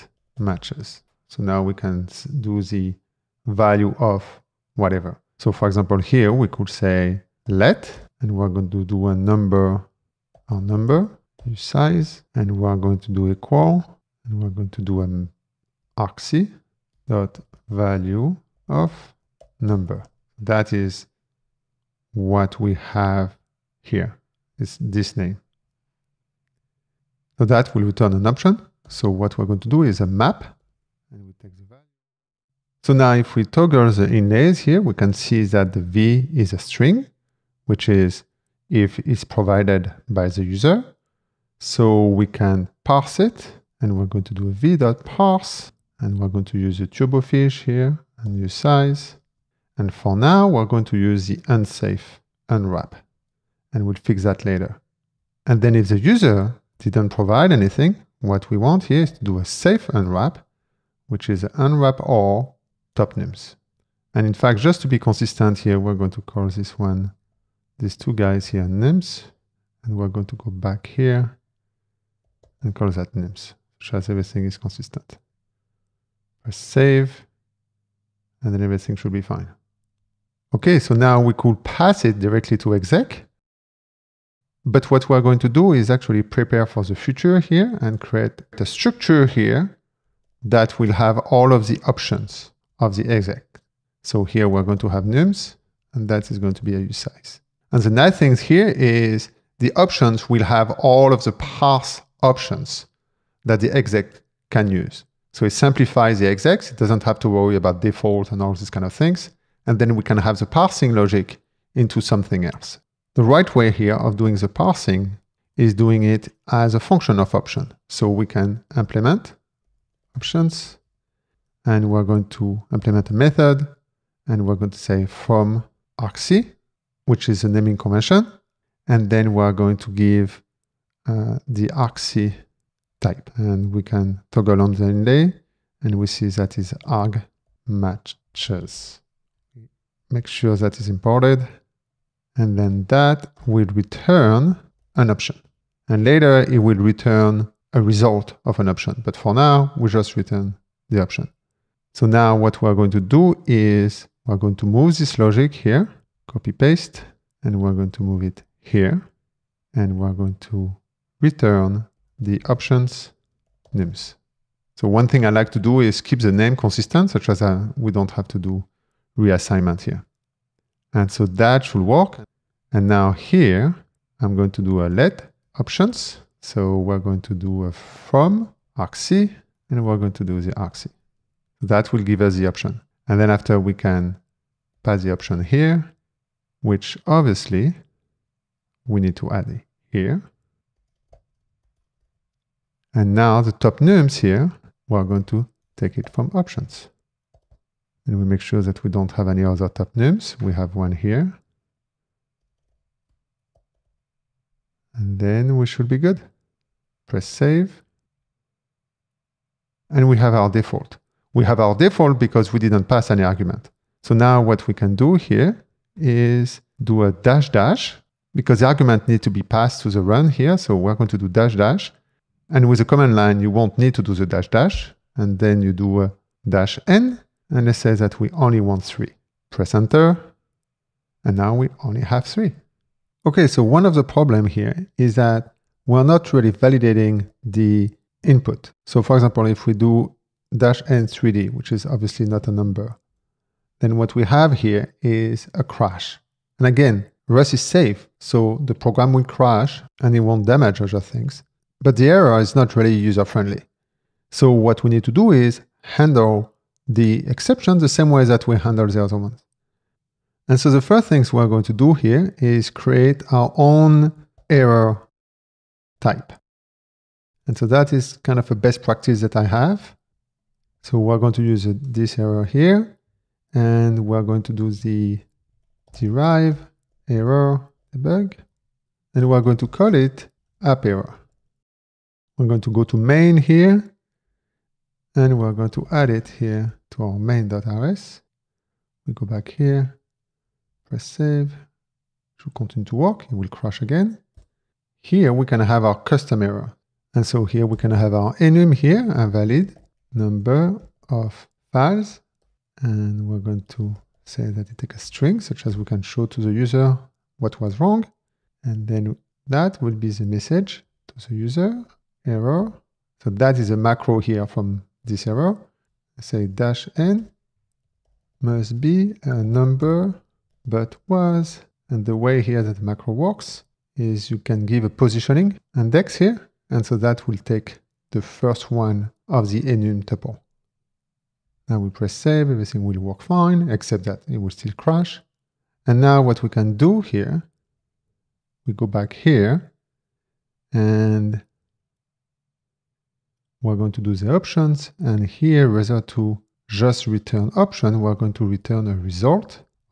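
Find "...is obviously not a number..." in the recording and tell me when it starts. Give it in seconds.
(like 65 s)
241 s.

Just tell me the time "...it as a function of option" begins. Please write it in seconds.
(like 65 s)
116 s.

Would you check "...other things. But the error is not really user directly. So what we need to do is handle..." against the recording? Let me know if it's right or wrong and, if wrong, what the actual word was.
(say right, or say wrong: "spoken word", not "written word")
wrong: "friendly", not "directly".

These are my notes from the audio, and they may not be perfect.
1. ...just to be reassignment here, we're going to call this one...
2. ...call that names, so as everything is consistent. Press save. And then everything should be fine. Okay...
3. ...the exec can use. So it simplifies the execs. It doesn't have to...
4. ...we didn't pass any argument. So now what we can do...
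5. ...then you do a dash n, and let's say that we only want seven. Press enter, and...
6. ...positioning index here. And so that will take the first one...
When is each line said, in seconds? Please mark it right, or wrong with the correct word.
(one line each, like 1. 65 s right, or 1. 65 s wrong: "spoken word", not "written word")
1. 64 s wrong: "consistent", not "reassignment"
2. 72 s right
3. 103 s right
4. 212 s right
5. 225 s wrong: "three", not "seven"
6. 324 s right.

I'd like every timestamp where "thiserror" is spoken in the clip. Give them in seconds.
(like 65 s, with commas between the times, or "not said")
271 s, 315 s.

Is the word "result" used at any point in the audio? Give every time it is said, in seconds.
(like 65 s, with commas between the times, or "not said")
147 s, 348 s.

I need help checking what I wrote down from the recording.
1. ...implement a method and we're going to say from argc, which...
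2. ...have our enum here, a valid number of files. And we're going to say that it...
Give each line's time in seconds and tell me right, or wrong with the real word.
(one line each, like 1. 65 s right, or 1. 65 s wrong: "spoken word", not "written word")
1. 122 s right
2. 297 s right.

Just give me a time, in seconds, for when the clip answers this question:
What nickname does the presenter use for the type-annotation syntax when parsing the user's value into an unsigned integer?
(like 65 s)
46 s.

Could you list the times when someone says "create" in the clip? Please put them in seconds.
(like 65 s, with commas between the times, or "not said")
87 s, 262 s.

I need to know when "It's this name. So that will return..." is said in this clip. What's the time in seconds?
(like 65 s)
24 s.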